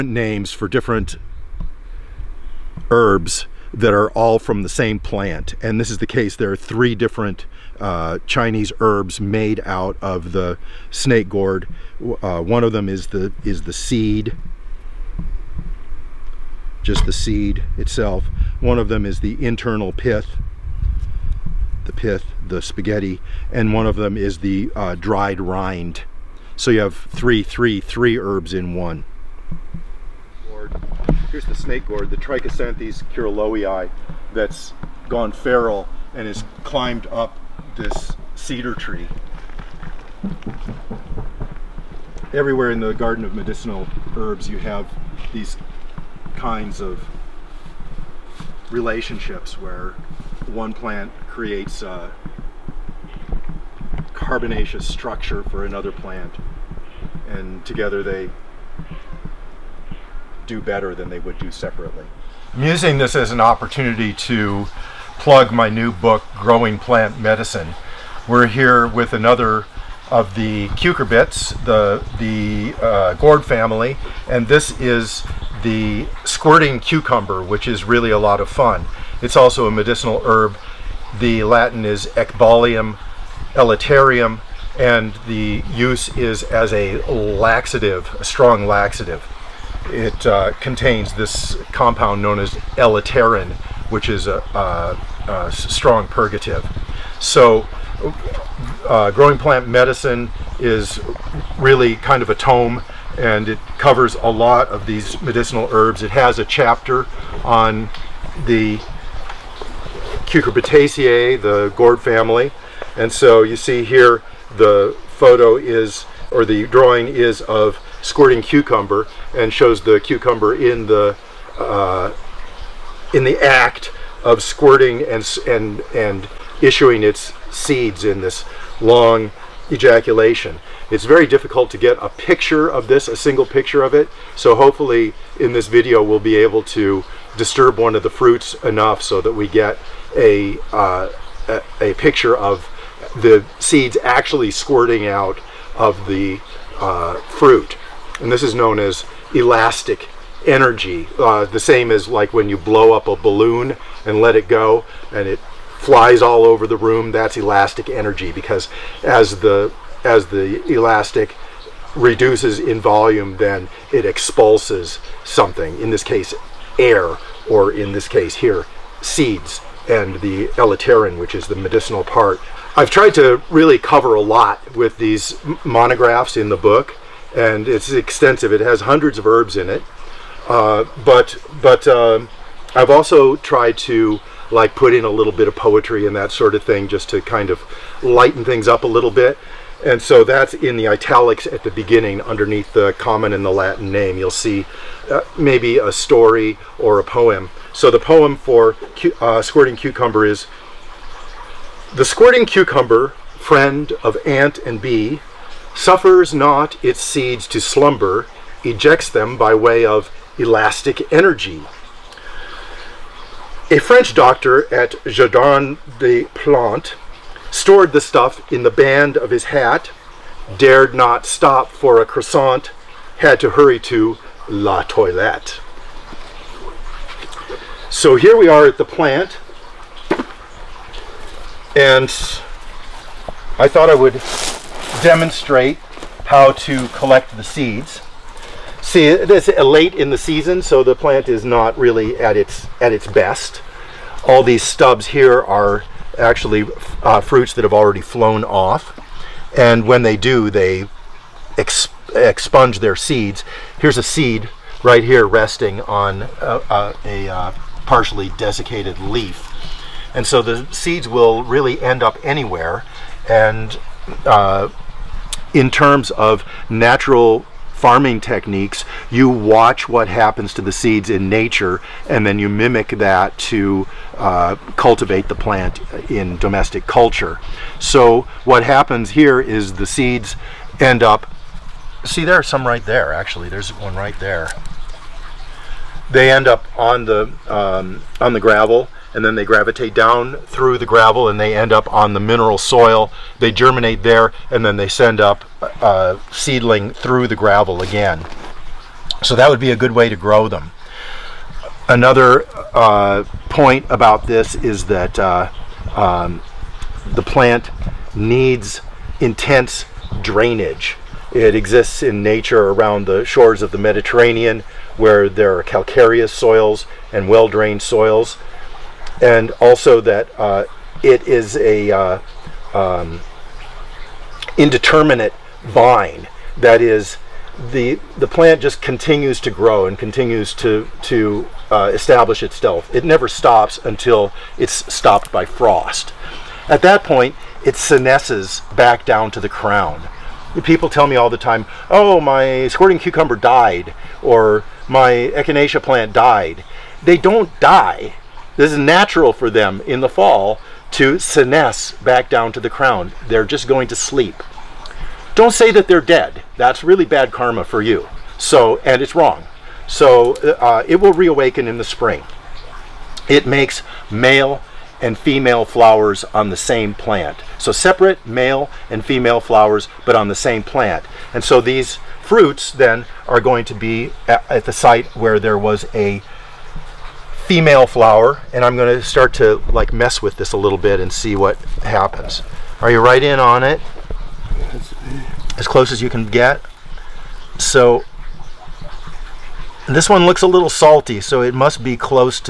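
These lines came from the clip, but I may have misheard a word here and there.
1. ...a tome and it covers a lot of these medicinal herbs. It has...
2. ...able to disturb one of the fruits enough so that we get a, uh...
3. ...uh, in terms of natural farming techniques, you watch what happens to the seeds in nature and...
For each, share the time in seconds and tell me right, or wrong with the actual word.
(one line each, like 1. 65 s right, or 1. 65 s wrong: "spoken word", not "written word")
1. 102 s right
2. 136 s right
3. 264 s right.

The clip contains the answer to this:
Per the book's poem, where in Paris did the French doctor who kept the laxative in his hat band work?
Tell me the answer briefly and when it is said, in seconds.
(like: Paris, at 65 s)
Jardin des Plantes, at 215 s.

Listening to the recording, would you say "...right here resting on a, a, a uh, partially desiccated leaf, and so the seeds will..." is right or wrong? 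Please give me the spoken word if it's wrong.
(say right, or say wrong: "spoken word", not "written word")
right.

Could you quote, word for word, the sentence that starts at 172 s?
I've tried to really cover a lot with these monographs in the book and it's extensive.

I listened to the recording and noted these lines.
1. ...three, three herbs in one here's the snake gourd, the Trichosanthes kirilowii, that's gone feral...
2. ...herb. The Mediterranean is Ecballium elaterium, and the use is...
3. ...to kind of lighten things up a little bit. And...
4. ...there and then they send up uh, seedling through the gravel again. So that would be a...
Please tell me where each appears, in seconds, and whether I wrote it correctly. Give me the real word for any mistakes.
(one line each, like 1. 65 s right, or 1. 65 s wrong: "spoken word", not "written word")
1. 27 s right
2. 80 s wrong: "Latin", not "Mediterranean"
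3. 187 s right
4. 294 s right.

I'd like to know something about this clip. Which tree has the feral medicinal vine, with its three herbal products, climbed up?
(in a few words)
Cedar.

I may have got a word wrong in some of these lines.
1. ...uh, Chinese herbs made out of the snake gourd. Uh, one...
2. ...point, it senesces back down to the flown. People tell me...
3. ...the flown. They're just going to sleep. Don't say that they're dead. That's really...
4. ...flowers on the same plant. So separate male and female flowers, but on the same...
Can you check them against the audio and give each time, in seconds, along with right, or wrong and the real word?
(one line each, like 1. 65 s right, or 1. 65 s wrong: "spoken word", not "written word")
1. 7 s right
2. 337 s wrong: "crown", not "flown"
3. 352 s wrong: "crown", not "flown"
4. 365 s right.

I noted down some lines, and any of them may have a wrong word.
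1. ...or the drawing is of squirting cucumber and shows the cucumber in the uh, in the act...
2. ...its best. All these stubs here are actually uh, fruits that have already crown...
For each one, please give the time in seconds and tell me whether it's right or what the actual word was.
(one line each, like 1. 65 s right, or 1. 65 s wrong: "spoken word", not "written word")
1. 116 s right
2. 242 s wrong: "flown", not "crown".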